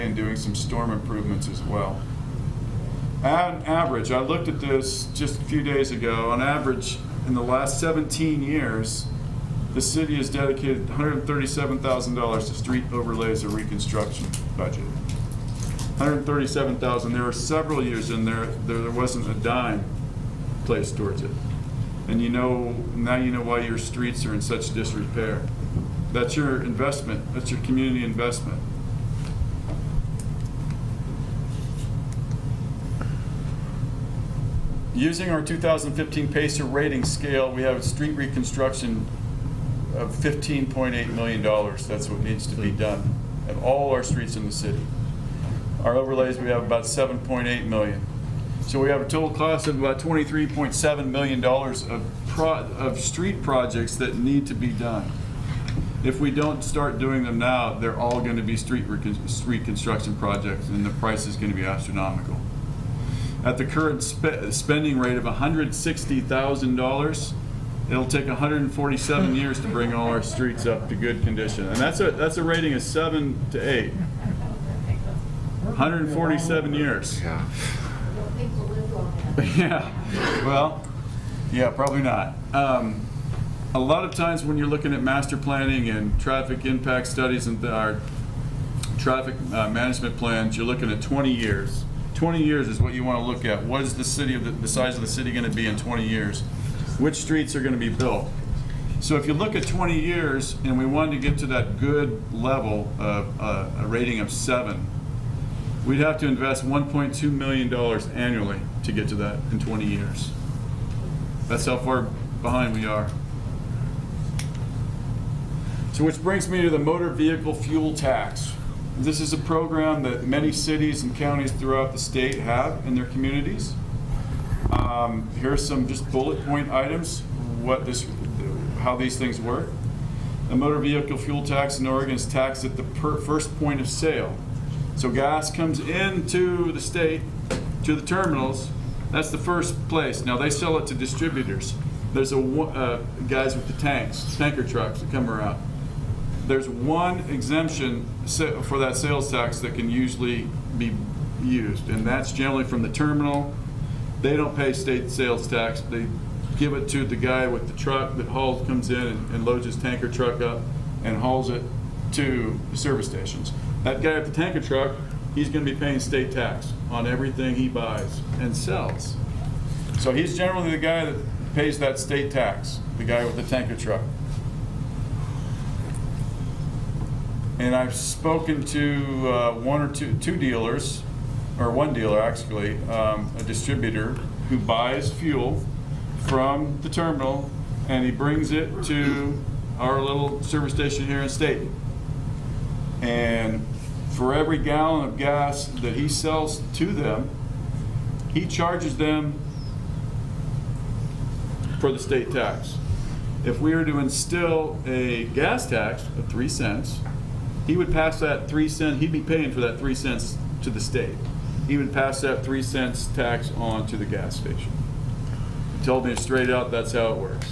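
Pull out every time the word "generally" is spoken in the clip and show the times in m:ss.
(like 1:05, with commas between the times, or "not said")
2:32, 2:50.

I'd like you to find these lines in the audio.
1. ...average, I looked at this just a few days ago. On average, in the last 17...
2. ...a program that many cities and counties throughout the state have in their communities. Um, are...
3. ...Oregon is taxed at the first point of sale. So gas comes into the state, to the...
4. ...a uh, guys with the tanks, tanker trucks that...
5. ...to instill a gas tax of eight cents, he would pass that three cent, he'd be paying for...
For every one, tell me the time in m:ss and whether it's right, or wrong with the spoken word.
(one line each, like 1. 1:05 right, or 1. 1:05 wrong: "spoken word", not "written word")
1. 0:03 right
2. 1:59 right
3. 2:11 right
4. 2:22 right
5. 3:23 wrong: "three", not "eight".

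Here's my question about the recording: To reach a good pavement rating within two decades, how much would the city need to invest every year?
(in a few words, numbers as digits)
$1.2 million.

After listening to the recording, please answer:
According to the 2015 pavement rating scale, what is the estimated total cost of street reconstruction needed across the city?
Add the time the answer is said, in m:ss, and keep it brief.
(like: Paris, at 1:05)
$15.8 million, at 0:40.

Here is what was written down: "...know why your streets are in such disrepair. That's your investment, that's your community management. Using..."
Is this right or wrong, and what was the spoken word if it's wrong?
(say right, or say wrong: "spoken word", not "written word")
wrong: "investment", not "management".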